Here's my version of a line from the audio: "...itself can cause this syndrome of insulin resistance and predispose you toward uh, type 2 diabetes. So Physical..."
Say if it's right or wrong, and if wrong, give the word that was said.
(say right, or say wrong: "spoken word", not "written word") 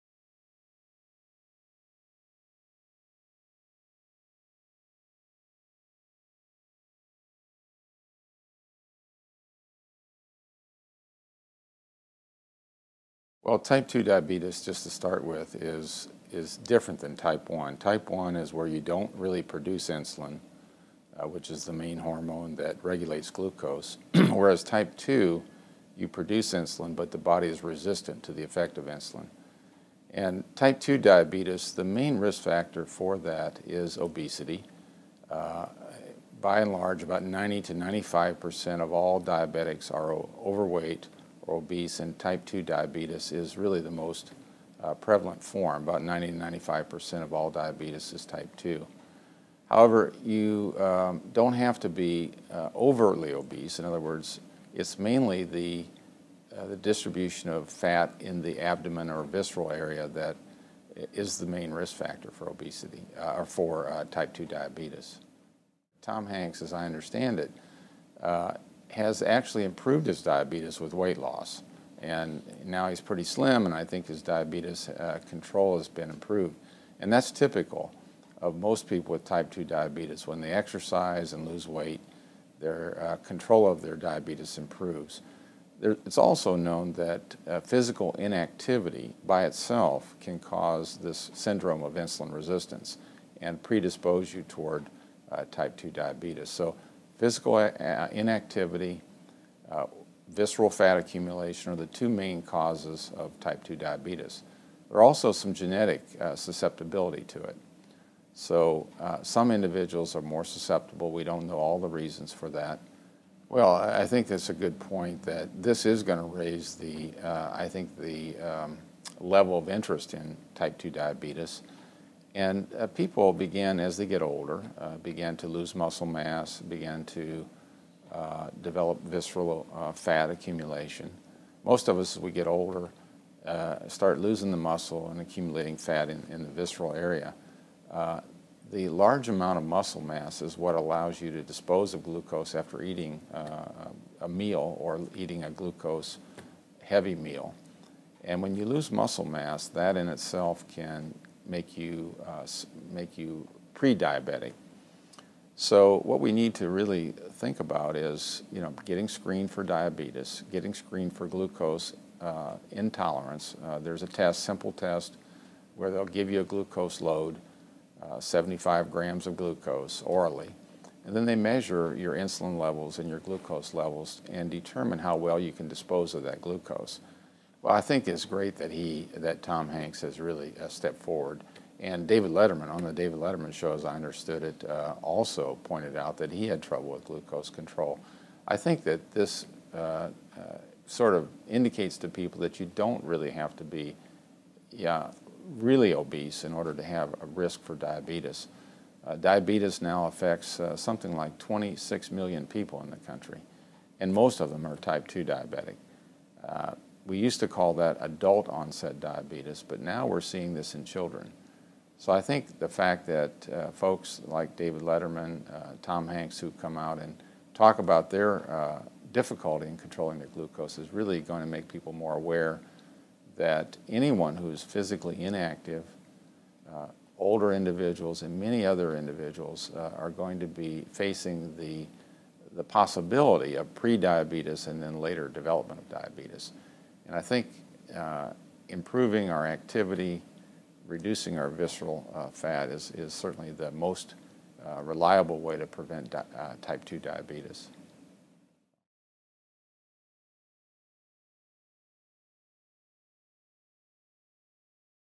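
right.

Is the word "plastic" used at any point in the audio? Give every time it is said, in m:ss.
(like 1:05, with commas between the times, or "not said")
not said.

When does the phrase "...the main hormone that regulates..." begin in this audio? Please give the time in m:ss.
0:21.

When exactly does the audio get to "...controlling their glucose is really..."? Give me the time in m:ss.
3:39.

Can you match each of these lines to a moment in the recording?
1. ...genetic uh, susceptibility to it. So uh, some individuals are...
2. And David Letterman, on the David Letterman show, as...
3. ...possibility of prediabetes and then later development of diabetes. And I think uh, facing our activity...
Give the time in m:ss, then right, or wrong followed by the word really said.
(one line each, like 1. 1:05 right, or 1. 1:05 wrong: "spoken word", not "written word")
1. 1:45 right
2. 3:01 right
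3. 3:52 wrong: "improving", not "facing".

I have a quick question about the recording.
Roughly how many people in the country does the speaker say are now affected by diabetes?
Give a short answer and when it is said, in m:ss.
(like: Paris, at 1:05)
26 million, at 3:21.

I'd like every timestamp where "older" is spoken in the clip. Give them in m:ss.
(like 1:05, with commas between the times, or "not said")
2:04, 2:12, 3:47.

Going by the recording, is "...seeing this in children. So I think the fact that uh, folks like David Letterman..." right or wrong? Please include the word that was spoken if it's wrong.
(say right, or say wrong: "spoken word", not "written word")
right.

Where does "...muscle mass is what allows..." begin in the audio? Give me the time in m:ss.
2:19.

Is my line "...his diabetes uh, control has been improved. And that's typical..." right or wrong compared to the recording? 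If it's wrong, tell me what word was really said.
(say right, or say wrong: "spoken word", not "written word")
right.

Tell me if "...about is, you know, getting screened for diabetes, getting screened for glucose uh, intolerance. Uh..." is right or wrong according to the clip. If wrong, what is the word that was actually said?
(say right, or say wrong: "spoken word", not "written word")
right.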